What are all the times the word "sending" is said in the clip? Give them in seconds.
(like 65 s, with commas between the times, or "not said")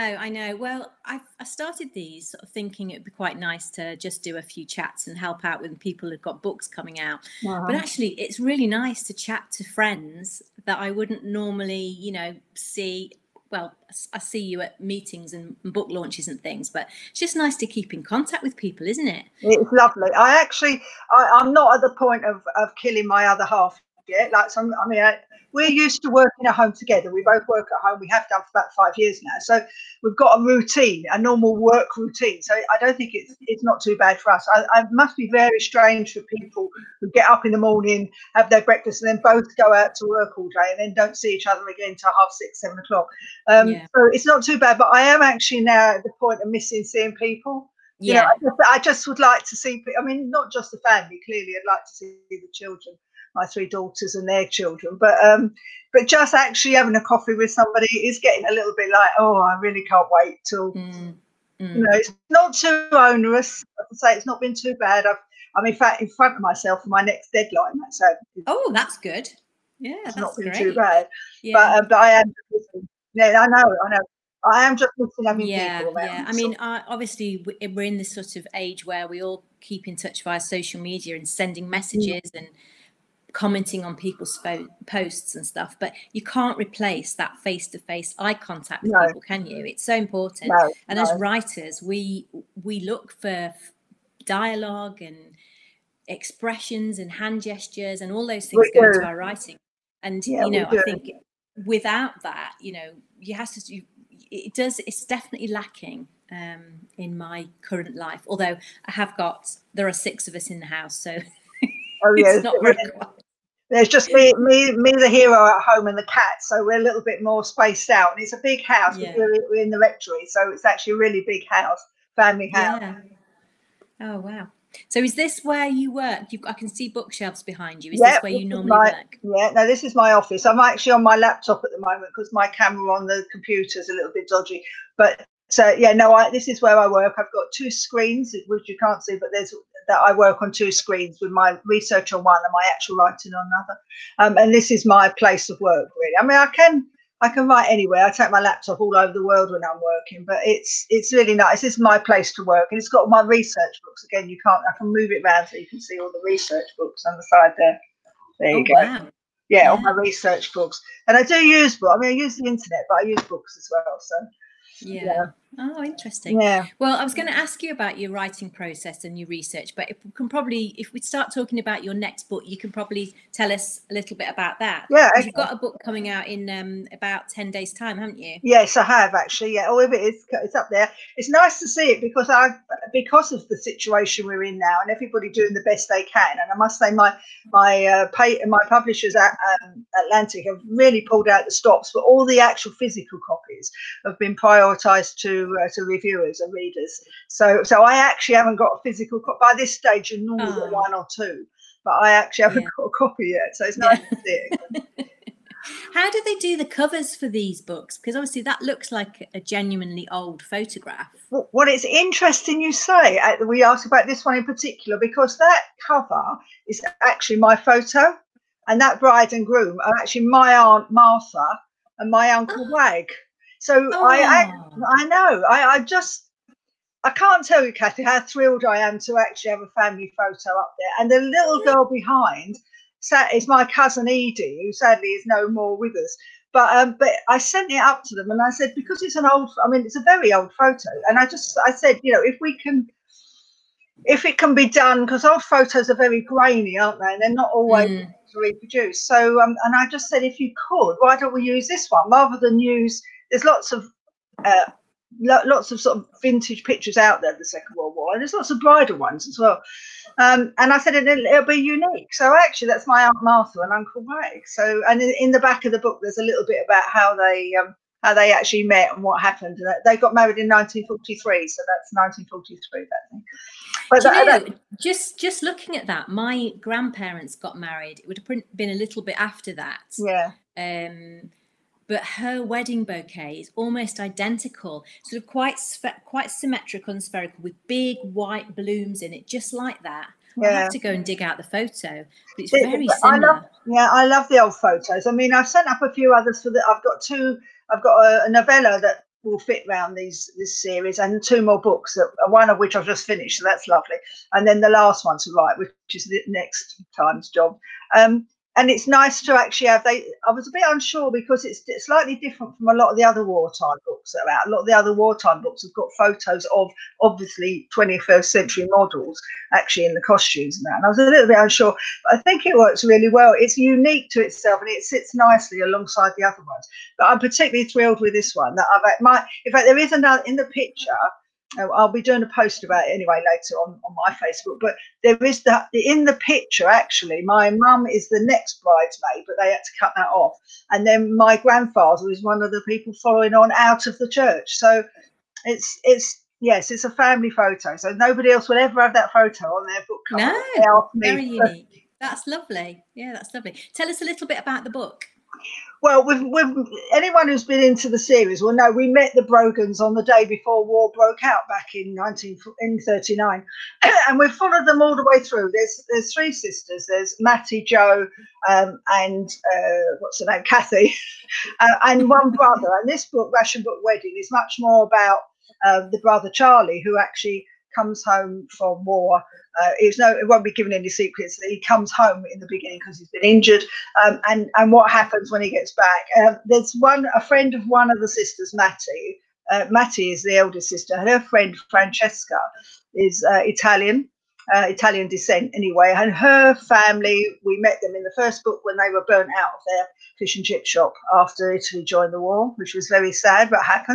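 81 s.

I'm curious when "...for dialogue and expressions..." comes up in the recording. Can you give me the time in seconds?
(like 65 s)
93 s.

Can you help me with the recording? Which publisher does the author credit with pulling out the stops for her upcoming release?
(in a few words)
Atlantic.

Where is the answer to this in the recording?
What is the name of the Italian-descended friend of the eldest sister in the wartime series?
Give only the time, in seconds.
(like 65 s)
391 s.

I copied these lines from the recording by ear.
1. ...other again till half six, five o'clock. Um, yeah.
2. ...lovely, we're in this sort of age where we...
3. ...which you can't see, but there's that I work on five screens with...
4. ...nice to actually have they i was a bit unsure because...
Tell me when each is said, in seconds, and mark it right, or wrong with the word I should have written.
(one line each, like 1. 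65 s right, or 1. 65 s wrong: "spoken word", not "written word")
1. 41 s wrong: "seven", not "five"
2. 76 s wrong: "obviously", not "lovely"
3. 138 s wrong: "two", not "five"
4. 308 s right.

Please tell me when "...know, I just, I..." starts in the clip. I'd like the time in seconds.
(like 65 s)
48 s.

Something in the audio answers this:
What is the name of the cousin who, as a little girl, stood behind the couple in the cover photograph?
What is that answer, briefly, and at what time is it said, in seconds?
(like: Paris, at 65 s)
Edie, at 234 s.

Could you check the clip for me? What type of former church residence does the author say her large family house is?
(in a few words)
The rectory.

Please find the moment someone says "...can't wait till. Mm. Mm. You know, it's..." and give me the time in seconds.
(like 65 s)
59 s.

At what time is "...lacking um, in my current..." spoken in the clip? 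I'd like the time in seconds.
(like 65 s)
105 s.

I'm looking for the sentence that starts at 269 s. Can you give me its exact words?
And they got married in 1943, so that's 1943.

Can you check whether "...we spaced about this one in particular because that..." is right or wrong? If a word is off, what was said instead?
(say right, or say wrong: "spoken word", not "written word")
wrong: "asked", not "spaced".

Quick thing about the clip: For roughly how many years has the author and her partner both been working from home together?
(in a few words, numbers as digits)
5.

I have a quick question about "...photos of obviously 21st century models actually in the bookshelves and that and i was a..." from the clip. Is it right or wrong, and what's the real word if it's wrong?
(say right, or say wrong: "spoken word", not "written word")
wrong: "costumes", not "bookshelves".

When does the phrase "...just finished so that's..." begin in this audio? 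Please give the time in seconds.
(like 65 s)
302 s.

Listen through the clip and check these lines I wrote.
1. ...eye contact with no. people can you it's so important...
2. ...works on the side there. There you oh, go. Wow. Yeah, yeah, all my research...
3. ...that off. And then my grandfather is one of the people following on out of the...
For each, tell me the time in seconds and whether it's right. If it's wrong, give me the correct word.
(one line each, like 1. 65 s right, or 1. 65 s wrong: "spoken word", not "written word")
1. 88 s right
2. 156 s wrong: "books", not "works"
3. 339 s right.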